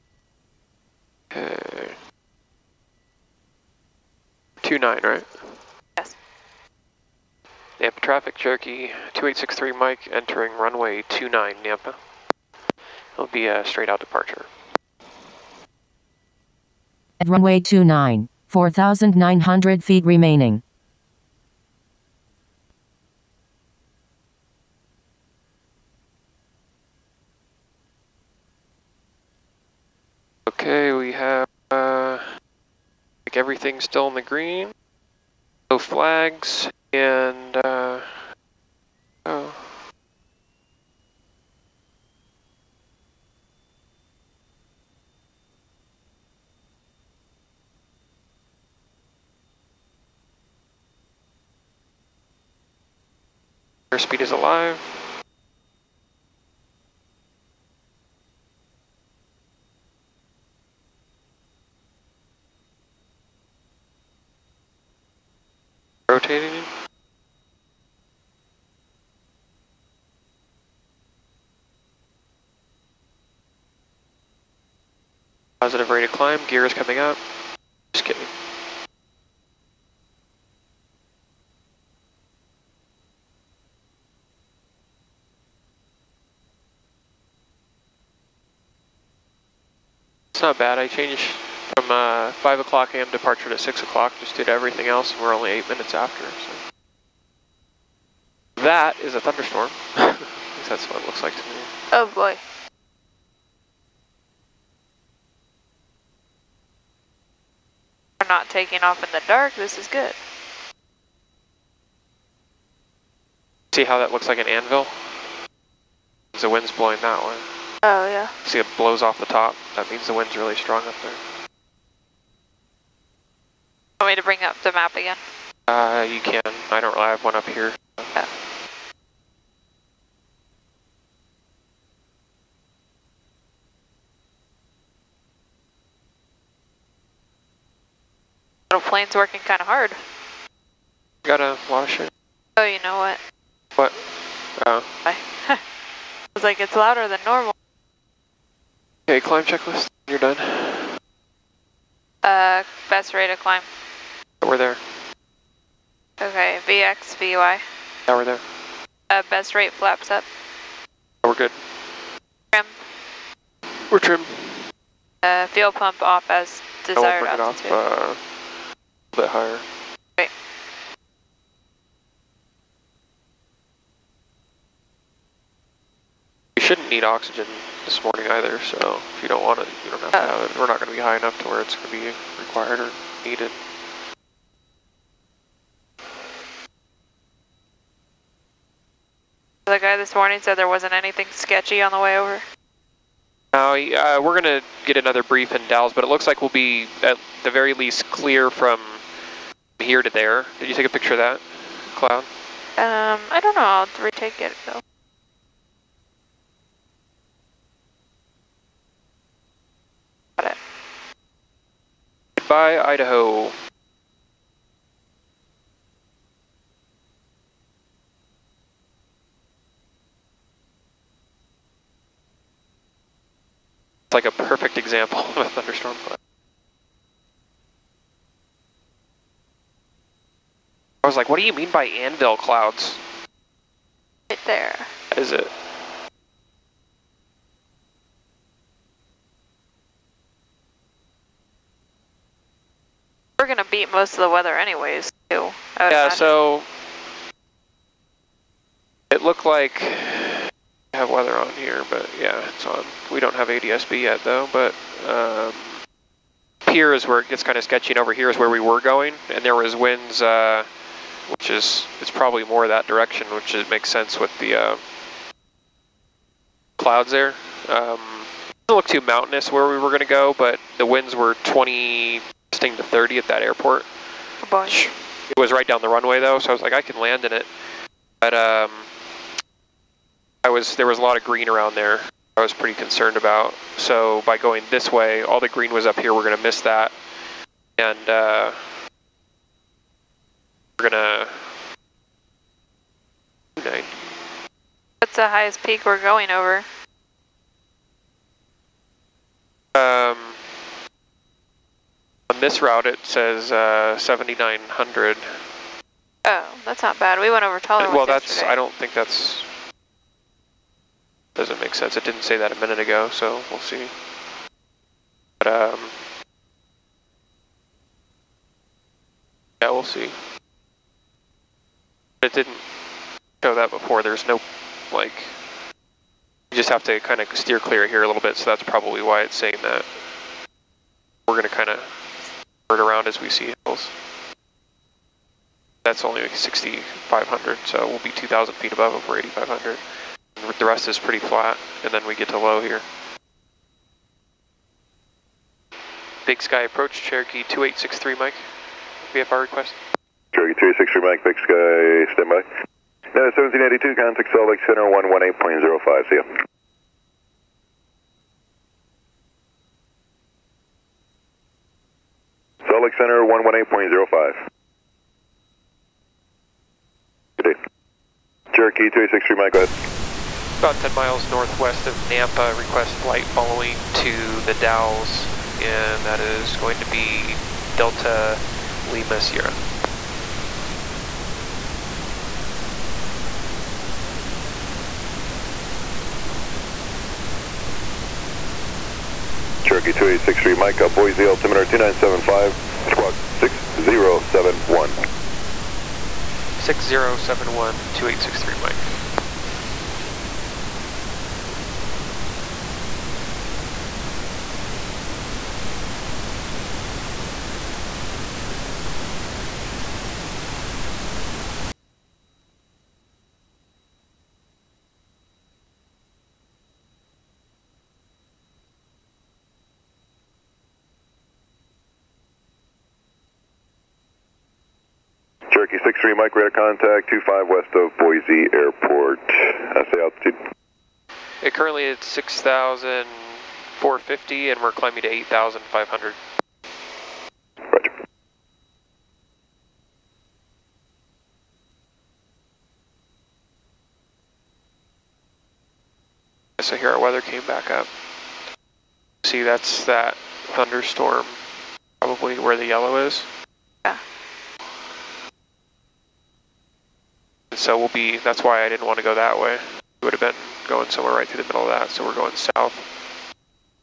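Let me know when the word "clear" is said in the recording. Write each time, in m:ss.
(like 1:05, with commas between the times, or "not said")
3:18, 5:27.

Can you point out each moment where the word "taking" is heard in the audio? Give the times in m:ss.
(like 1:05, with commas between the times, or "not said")
1:48.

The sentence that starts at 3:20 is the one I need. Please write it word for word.
Did you take a picture of that cloud?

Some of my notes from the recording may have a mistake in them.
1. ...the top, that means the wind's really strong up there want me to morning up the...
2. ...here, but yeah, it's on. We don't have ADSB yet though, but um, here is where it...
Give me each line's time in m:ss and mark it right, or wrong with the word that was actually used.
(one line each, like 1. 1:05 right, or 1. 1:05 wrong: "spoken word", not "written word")
1. 1:59 wrong: "bring", not "morning"
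2. 4:11 right.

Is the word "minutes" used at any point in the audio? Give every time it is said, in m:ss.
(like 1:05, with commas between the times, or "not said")
1:35, 5:12.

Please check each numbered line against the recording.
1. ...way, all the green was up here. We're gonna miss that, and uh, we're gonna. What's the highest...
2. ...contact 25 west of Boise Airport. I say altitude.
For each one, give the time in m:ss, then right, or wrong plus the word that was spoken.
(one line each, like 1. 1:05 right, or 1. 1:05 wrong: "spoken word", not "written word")
1. 4:44 right
2. 7:06 right.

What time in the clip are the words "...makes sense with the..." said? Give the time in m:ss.
4:23.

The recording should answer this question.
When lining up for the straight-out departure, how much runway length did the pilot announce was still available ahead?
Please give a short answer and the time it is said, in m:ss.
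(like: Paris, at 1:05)
4,900 feet, at 0:18.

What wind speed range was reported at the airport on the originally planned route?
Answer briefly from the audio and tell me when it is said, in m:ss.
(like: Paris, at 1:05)
20 to 30, at 4:31.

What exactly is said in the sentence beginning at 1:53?
See how that looks like an anvil?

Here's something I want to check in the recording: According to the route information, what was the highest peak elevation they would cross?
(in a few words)
7,900.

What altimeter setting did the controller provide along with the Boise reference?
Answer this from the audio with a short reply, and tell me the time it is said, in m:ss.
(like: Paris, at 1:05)
29.75, at 6:31.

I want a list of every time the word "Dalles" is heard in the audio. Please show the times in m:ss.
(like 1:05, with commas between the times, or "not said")
3:15, 6:14.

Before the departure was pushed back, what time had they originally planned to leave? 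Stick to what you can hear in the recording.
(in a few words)
5 a.m.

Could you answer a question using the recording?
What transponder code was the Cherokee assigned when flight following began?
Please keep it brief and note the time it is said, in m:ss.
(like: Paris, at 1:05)
6071, at 6:32.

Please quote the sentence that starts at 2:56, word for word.
shouldn't need oxygen this morning either, so if you don't want it, you don't have oh.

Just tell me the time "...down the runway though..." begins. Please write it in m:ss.
4:35.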